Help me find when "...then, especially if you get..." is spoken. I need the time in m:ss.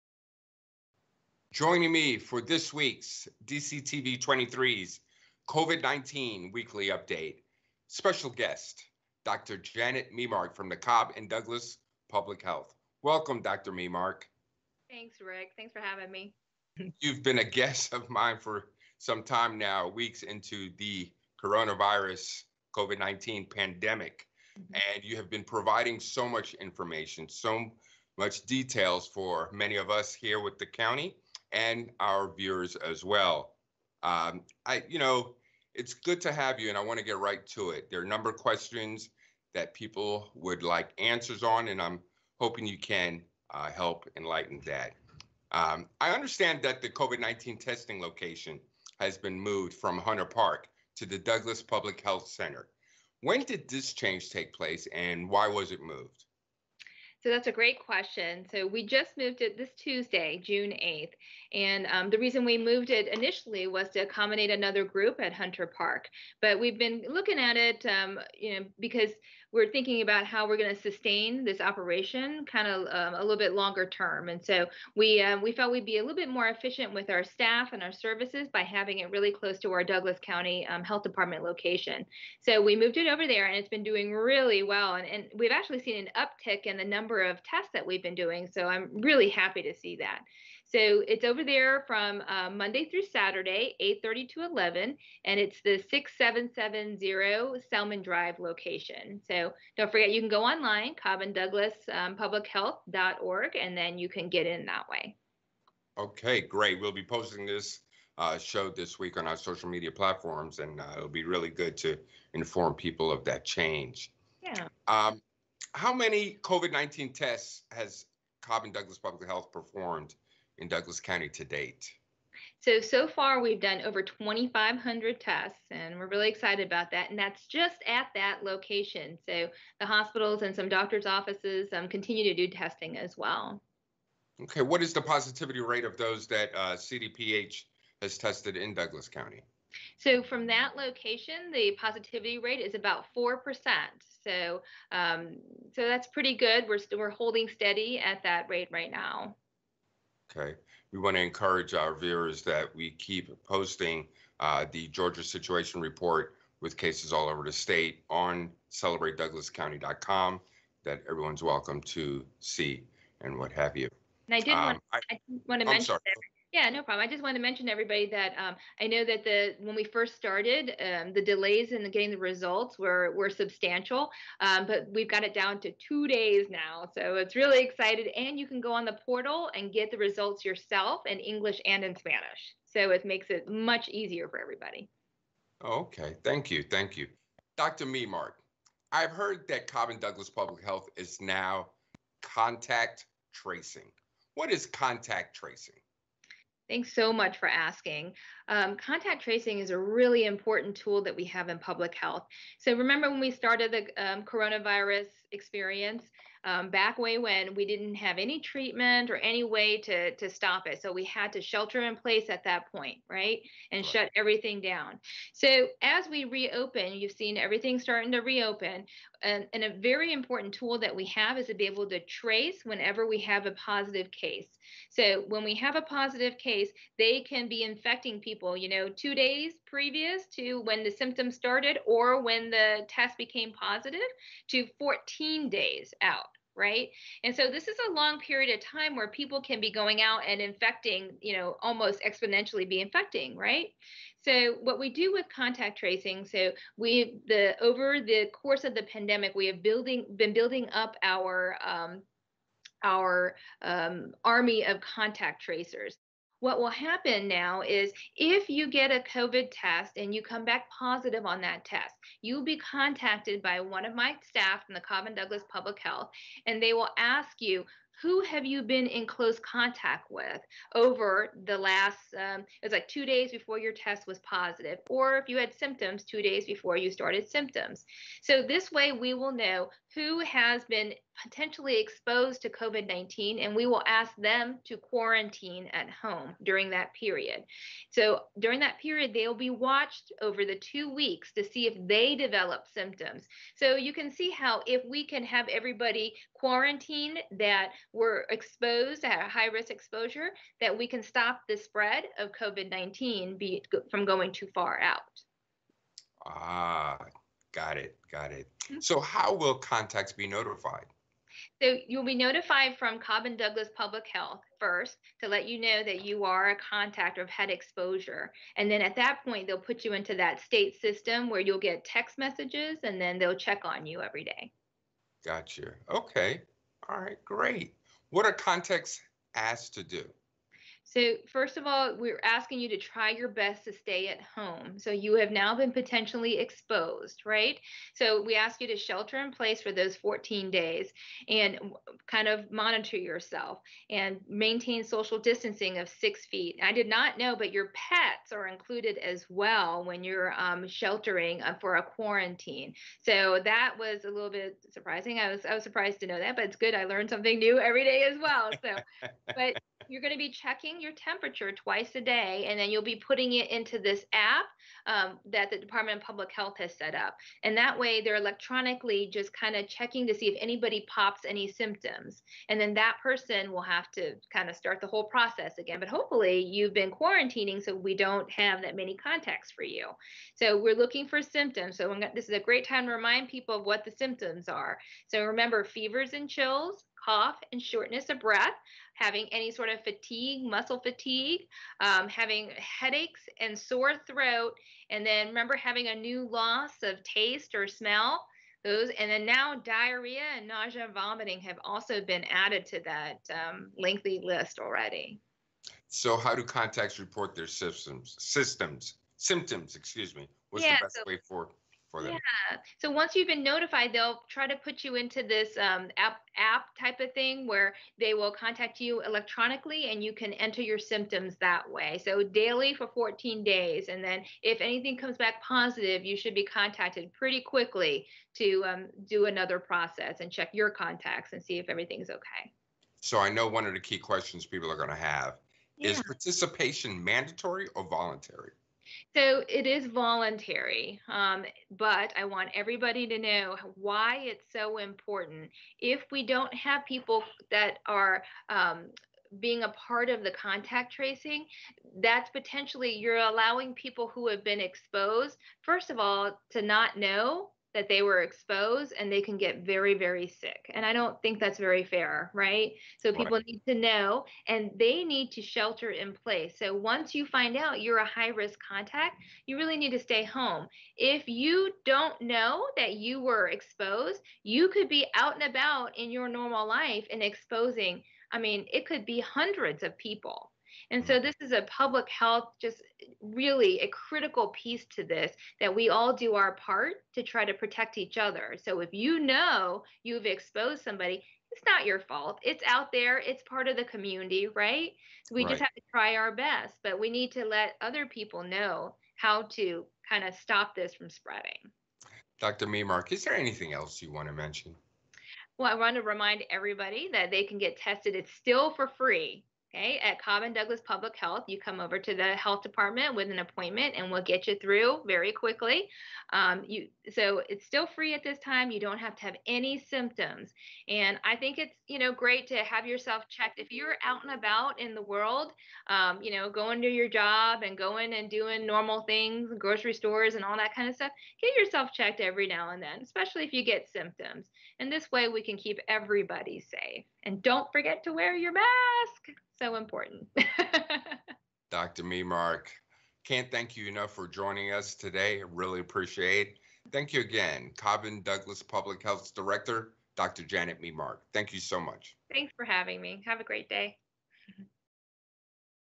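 8:52.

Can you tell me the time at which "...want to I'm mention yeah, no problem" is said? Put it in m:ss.
2:45.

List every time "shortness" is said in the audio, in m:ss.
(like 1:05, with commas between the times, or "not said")
6:27.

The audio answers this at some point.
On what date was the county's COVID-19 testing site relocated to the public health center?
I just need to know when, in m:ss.
1:00.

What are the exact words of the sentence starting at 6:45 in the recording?
So, how do contacts report their systems?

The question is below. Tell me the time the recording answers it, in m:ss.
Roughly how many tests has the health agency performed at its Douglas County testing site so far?
2:03.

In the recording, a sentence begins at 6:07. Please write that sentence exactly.
And that way, they're electronically just kind of checking to see if anybody pops any symptoms.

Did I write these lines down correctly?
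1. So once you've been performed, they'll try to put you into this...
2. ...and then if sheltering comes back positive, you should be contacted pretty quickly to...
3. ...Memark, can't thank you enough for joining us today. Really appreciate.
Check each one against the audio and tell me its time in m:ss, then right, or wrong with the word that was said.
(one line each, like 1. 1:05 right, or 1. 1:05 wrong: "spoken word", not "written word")
1. 6:52 wrong: "notified", not "performed"
2. 7:03 wrong: "anything", not "sheltering"
3. 9:02 right.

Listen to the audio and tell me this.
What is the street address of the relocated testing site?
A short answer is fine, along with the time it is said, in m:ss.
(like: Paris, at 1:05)
6770 Selman Drive, at 1:35.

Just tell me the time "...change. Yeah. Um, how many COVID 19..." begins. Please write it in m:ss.
1:53.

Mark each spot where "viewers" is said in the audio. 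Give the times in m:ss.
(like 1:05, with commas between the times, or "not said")
0:32, 2:31.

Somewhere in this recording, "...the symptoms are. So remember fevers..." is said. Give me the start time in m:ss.
6:23.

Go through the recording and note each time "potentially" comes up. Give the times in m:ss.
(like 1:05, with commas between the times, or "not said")
4:41, 5:35, 7:32.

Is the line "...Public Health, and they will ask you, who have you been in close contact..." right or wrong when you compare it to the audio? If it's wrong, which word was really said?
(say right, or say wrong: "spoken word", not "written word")
right.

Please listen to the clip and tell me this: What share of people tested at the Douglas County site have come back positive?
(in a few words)
4 percent.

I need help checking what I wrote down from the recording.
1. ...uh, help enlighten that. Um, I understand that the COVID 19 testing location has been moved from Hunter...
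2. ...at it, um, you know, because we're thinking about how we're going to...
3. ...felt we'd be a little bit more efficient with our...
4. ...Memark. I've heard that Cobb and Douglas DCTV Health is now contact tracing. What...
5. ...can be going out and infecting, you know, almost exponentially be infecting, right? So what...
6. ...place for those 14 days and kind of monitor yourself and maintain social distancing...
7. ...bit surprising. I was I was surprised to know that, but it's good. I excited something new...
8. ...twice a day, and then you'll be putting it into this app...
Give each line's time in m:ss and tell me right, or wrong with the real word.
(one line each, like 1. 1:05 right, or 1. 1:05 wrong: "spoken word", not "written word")
1. 0:43 right
2. 1:07 right
3. 1:15 right
4. 3:07 wrong: "Public", not "DCTV"
5. 3:59 right
6. 5:39 right
7. 5:54 wrong: "learned", not "excited"
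8. 6:01 right.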